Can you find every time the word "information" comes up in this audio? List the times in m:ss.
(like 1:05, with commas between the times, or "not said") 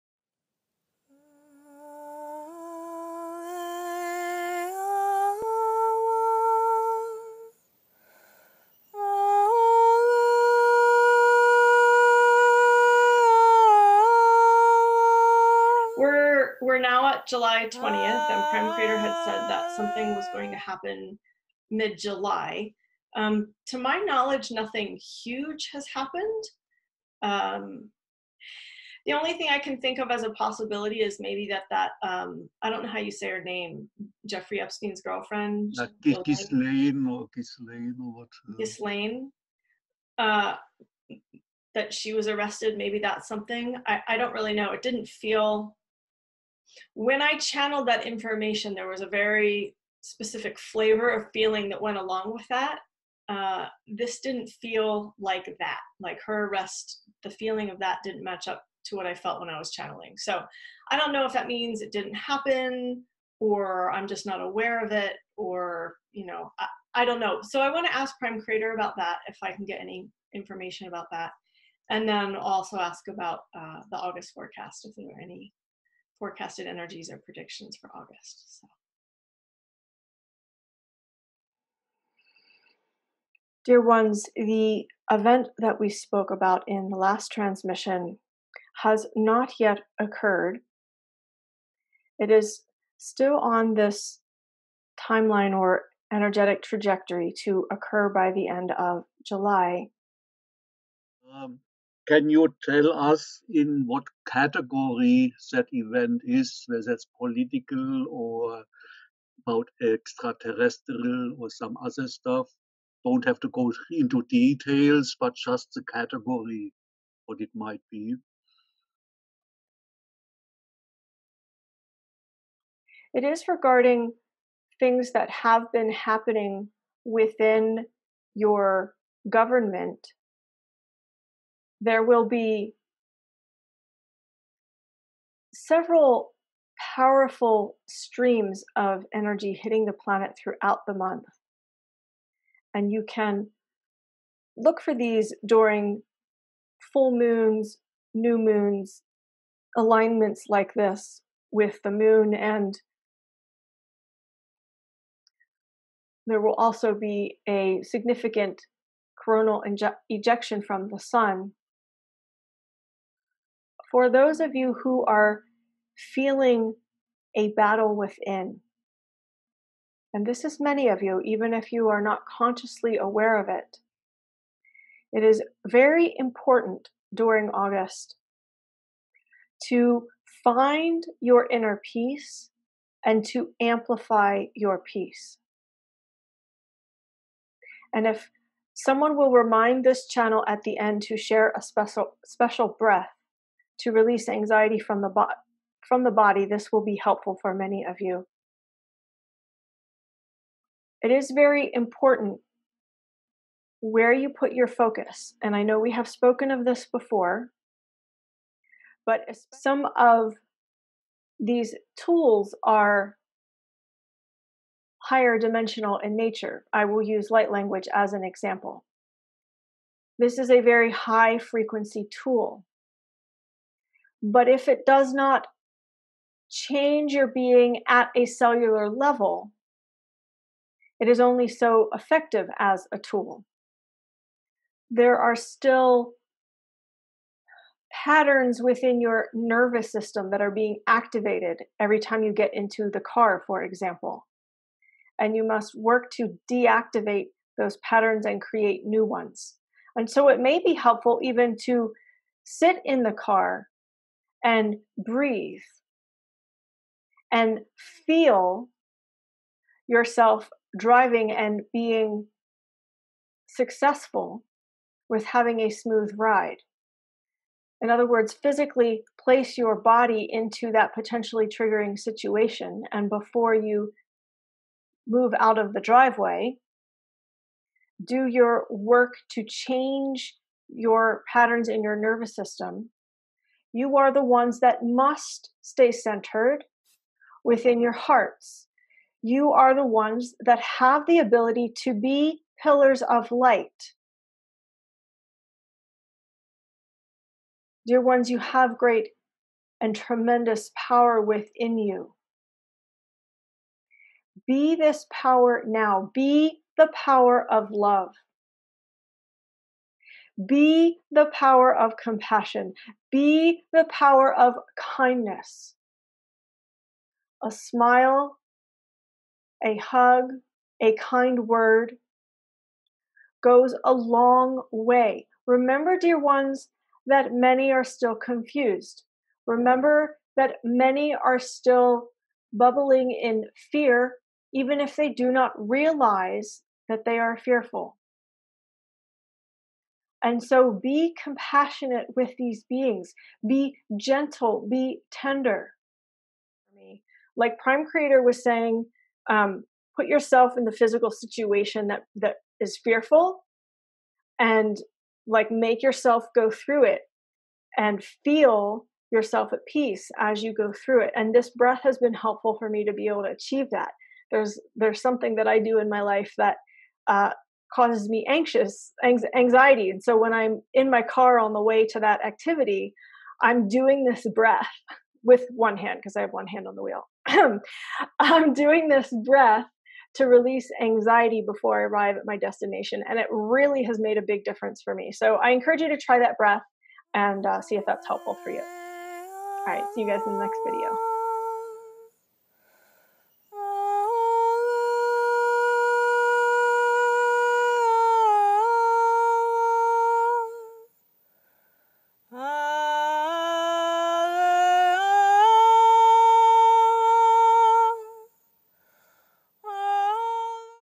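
0:48, 1:10.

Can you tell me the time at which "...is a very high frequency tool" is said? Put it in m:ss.
3:40.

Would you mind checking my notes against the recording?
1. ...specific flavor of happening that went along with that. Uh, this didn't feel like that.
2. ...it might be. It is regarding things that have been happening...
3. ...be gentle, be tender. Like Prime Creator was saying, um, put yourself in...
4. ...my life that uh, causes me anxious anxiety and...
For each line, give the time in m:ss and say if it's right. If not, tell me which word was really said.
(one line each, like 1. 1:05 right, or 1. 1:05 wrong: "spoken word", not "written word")
1. 0:50 wrong: "feeling", not "happening"
2. 1:57 right
3. 5:43 right
4. 6:05 right.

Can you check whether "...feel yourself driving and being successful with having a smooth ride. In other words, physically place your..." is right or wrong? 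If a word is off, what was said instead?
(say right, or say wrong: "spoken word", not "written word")
right.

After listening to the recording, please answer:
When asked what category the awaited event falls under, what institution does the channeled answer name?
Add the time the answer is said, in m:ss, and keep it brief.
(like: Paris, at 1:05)
Government, at 2:09.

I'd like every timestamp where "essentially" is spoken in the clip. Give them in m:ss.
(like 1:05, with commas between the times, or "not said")
not said.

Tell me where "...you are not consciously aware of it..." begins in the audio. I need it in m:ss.
2:51.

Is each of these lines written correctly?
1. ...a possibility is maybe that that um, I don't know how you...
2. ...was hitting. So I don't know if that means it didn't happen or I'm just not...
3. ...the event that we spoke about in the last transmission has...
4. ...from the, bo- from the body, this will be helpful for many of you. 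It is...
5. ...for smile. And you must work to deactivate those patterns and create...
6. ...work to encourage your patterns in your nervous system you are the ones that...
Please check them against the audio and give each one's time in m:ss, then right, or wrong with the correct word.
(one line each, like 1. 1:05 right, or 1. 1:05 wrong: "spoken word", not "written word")
1. 0:30 right
2. 0:59 wrong: "channeling", not "hitting"
3. 1:24 right
4. 3:14 right
5. 4:03 wrong: "example", not "smile"
6. 4:38 wrong: "change", not "encourage".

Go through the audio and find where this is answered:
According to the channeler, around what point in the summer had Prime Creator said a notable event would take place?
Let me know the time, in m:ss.
0:21.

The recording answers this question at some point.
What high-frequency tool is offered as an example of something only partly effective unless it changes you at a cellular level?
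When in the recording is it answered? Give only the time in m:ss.
3:37.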